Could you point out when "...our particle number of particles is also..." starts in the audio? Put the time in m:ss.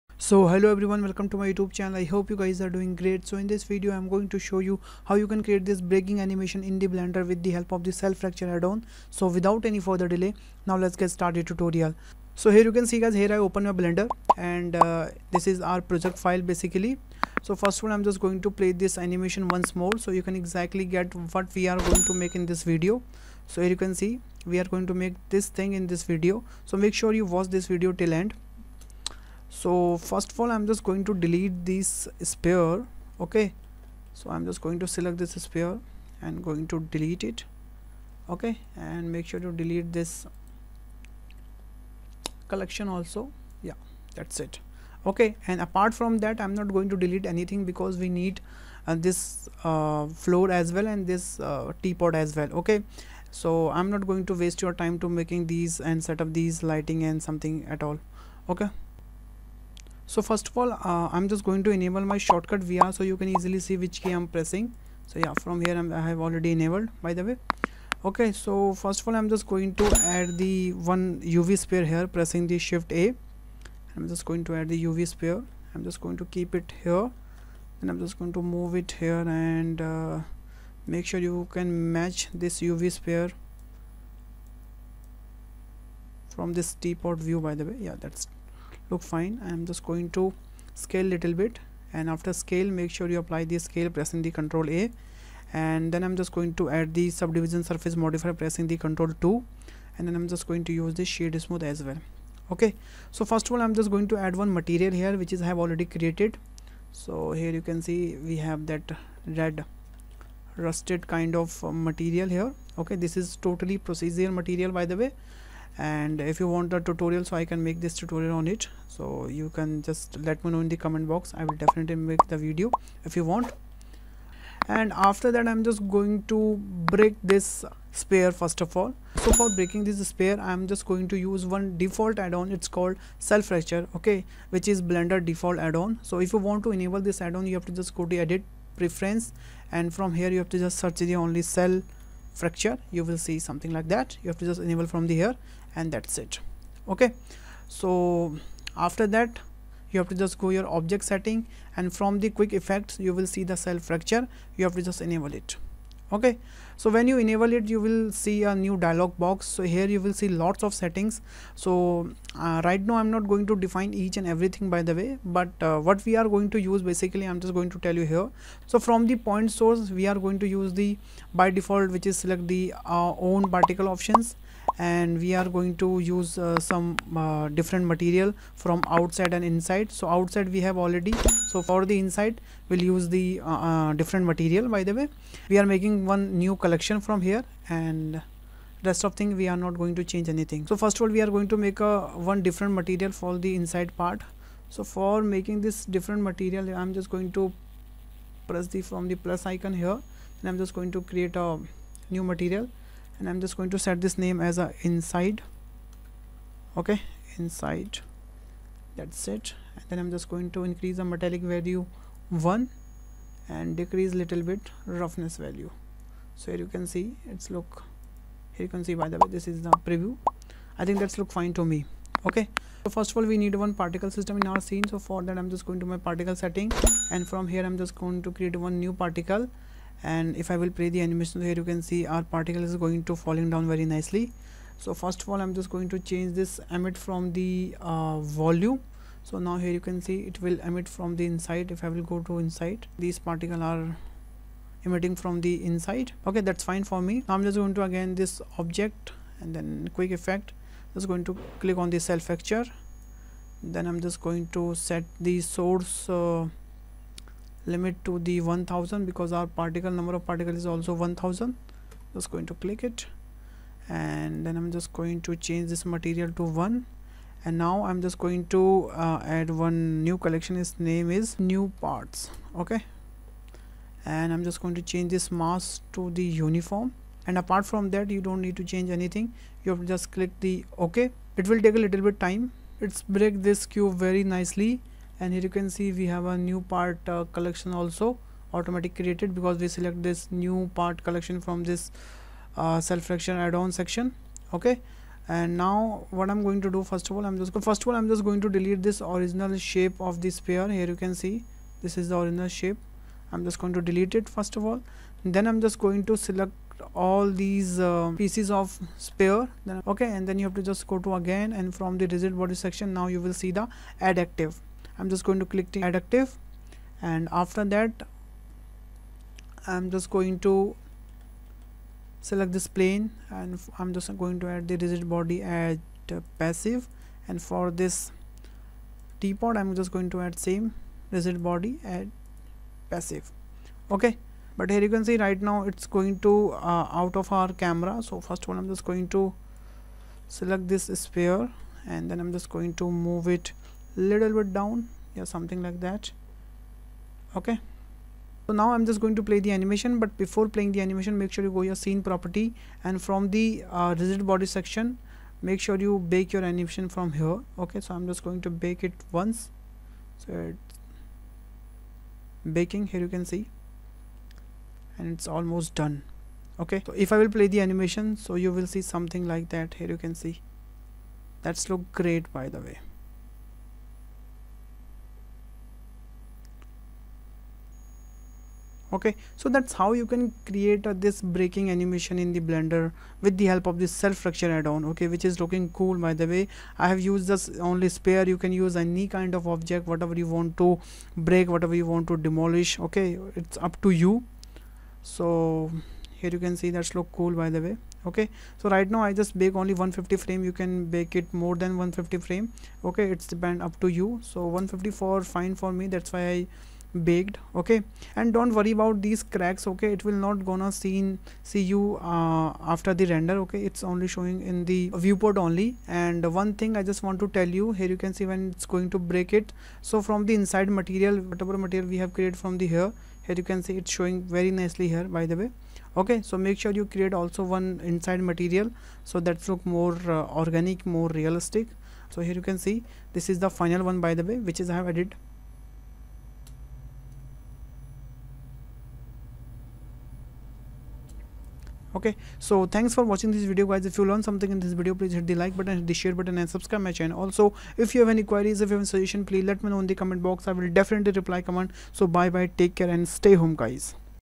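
4:19.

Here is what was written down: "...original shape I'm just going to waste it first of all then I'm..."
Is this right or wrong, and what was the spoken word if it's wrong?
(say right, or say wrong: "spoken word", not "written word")
wrong: "delete", not "waste".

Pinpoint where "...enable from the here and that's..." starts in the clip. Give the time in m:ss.
2:24.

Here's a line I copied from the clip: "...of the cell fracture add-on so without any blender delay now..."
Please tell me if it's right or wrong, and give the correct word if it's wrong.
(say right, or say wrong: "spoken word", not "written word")
wrong: "further", not "blender".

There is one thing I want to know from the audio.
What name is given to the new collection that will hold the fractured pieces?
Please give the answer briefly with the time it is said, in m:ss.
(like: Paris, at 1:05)
new parts, at 4:31.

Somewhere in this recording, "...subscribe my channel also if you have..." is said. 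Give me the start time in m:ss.
7:26.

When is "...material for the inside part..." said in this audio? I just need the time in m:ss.
3:12.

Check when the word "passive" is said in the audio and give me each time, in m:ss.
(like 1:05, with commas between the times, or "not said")
5:26, 5:32.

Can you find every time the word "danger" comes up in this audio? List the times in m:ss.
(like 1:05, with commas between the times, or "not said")
not said.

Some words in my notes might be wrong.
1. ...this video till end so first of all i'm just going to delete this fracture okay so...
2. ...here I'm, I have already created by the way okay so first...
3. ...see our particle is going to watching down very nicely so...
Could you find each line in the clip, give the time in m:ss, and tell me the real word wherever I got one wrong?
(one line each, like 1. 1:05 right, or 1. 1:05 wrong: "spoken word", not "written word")
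1. 0:27 wrong: "sphere", not "fracture"
2. 1:05 wrong: "enabled", not "created"
3. 3:51 wrong: "falling", not "watching".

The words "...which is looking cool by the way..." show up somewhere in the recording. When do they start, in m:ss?
6:25.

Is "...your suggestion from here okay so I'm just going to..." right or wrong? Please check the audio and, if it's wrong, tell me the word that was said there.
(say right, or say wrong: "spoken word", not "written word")
wrong: "animation", not "suggestion".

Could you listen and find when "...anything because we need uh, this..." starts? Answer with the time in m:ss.
0:47.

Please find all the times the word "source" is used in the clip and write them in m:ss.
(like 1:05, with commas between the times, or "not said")
2:49, 4:15.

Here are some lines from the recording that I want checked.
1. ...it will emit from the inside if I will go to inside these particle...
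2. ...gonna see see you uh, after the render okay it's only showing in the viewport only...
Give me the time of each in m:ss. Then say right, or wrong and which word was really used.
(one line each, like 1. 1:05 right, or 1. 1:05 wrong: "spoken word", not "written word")
1. 4:00 right
2. 6:50 right.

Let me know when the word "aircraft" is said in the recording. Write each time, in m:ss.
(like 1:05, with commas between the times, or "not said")
not said.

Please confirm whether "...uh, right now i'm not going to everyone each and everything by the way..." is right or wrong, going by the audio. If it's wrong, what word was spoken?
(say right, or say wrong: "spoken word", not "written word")
wrong: "define", not "everyone".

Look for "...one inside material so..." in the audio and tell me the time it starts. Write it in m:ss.
7:07.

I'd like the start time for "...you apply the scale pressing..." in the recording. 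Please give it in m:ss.
1:33.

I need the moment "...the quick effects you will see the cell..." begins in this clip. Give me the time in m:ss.
2:32.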